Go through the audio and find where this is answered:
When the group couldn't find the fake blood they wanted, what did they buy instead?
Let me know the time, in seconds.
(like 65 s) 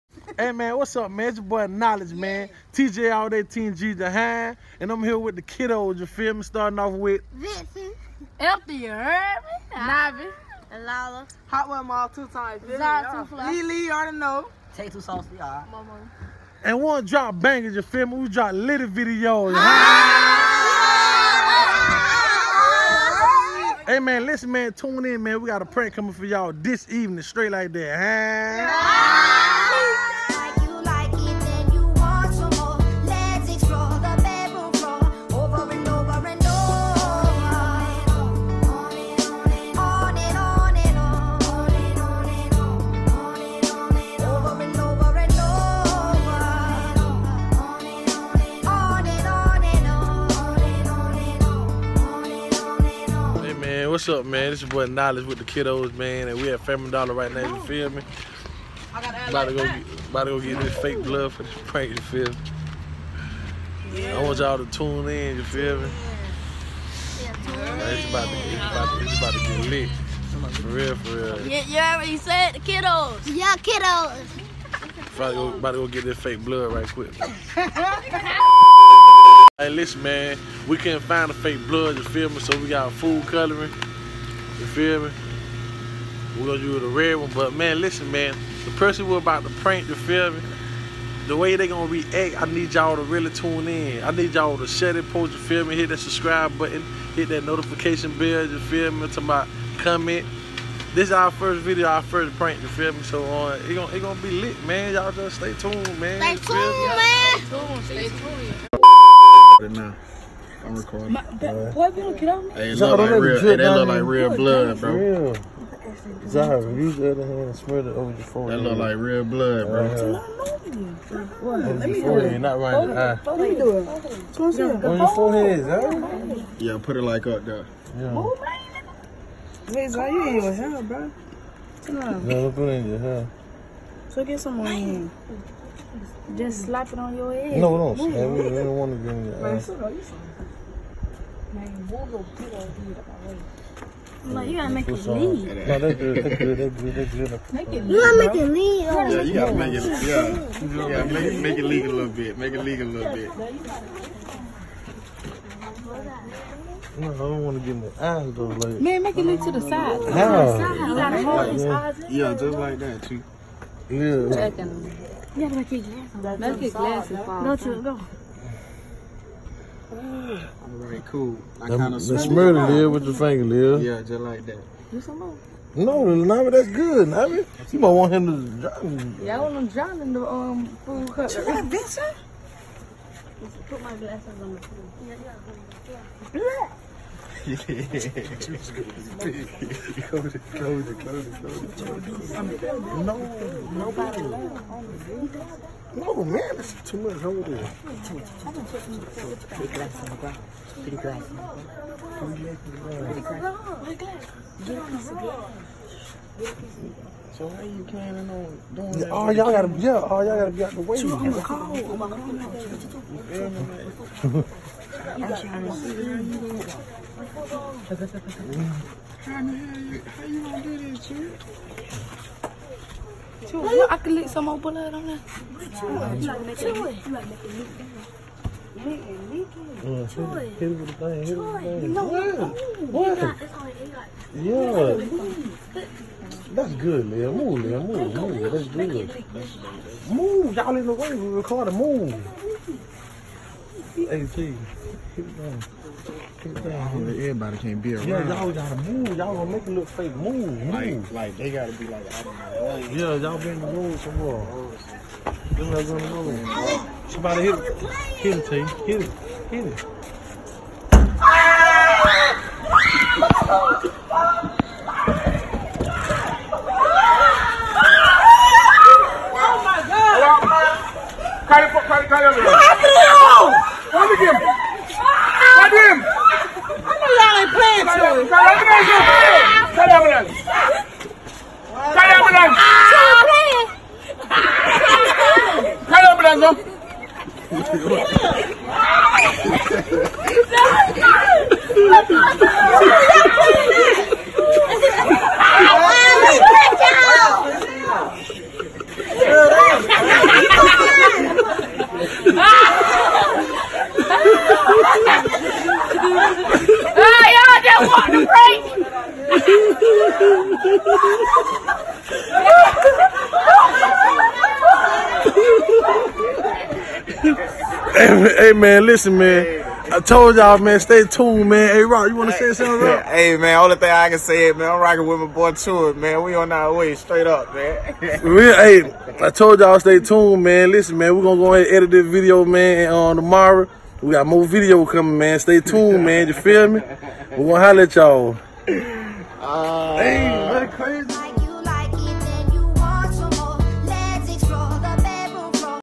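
82 s.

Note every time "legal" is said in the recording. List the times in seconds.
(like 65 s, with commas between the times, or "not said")
147 s, 152 s.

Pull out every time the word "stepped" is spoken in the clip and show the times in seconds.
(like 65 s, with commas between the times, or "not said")
not said.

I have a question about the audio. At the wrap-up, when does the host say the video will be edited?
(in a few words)
Tomorrow.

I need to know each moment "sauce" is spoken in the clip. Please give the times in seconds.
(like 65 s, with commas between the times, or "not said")
14 s.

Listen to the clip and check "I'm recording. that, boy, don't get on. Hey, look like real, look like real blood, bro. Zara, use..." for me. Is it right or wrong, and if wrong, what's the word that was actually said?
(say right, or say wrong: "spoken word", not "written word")
right.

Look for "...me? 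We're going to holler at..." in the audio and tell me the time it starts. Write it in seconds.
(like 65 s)
336 s.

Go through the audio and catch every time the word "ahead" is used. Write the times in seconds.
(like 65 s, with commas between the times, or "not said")
331 s.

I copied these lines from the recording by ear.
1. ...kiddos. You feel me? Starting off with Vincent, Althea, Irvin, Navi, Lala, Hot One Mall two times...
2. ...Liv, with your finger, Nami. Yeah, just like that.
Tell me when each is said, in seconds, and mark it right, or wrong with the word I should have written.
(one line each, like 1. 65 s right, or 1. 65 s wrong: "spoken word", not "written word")
1. 5 s right
2. 172 s wrong: "Liv", not "Nami".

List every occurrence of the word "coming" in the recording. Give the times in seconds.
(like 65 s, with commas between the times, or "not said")
25 s, 334 s.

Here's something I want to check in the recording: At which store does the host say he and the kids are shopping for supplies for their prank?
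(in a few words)
Family Dollar.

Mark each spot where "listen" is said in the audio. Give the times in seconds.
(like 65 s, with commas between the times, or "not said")
24 s, 79 s, 87 s, 318 s, 330 s.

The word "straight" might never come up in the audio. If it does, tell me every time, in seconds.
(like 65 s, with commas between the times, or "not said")
27 s, 326 s.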